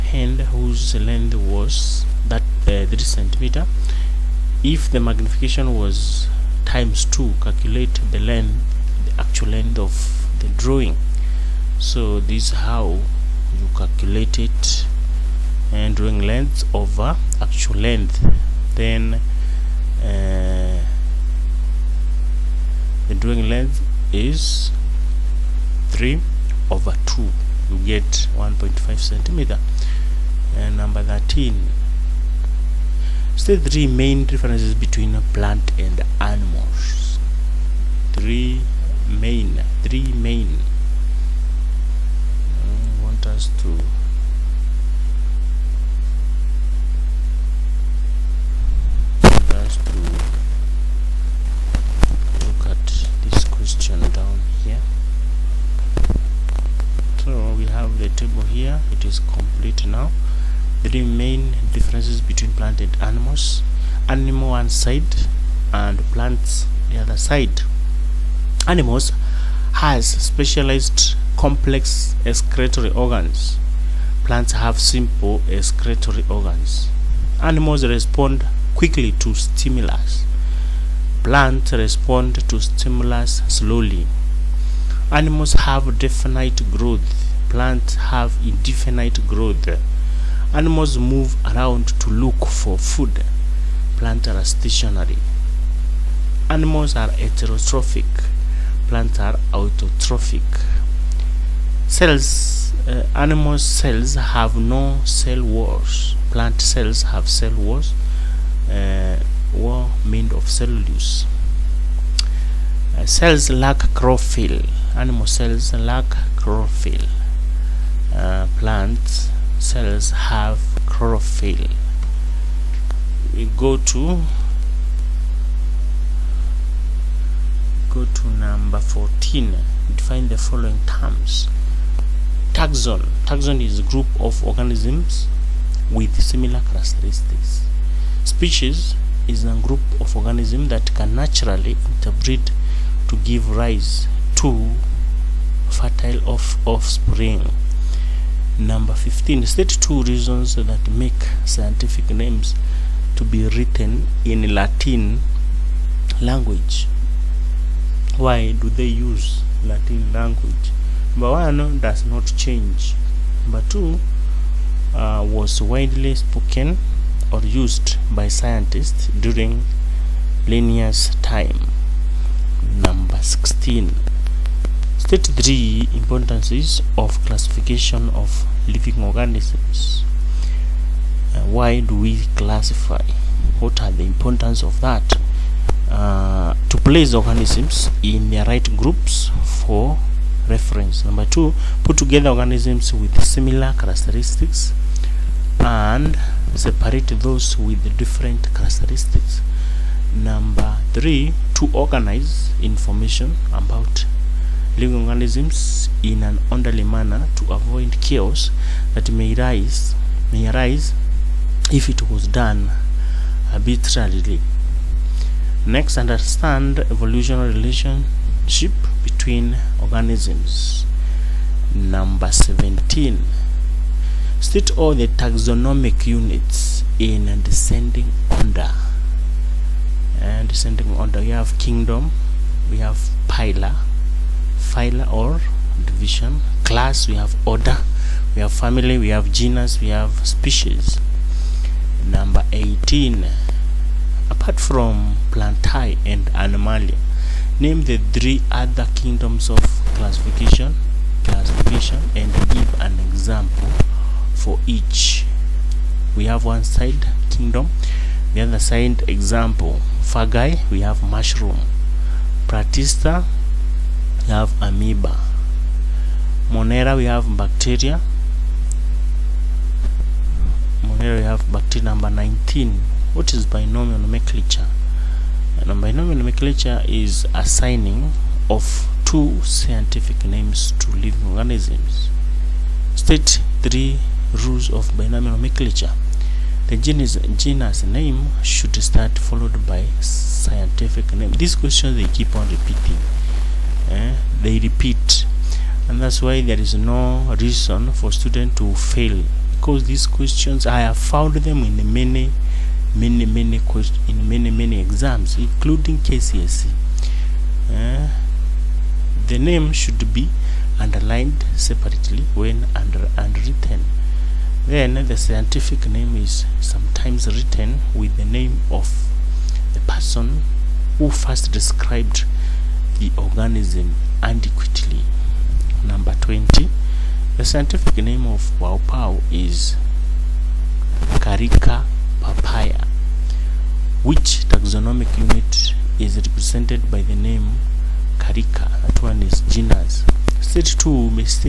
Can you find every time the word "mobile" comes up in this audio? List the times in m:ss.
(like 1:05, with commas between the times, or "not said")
not said.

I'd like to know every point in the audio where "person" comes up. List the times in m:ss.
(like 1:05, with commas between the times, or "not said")
5:19.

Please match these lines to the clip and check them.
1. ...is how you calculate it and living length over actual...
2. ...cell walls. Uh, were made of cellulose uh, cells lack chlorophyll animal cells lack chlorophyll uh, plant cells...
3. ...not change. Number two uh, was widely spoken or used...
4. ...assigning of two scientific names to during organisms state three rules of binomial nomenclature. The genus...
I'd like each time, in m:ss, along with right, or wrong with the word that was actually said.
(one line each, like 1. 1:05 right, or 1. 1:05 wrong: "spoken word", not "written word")
1. 0:12 wrong: "drawing", not "living"
2. 1:47 right
3. 2:42 right
4. 4:37 wrong: "living", not "during".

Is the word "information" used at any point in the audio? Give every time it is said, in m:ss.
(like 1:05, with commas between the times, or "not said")
3:22.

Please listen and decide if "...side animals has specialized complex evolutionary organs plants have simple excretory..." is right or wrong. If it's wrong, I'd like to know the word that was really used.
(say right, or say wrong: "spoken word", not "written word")
wrong: "excretory", not "evolutionary".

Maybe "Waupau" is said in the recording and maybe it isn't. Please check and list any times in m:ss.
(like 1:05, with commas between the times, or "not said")
5:28.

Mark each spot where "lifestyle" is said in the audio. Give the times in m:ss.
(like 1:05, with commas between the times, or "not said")
not said.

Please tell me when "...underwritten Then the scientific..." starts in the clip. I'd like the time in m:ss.
5:13.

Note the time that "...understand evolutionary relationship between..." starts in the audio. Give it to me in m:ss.
3:35.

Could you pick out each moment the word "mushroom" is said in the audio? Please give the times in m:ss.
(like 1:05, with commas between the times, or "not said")
4:21.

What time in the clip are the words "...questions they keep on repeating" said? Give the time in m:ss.
4:51.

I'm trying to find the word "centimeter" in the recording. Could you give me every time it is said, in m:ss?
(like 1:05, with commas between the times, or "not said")
0:02, 0:28.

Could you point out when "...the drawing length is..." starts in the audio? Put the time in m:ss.
0:23.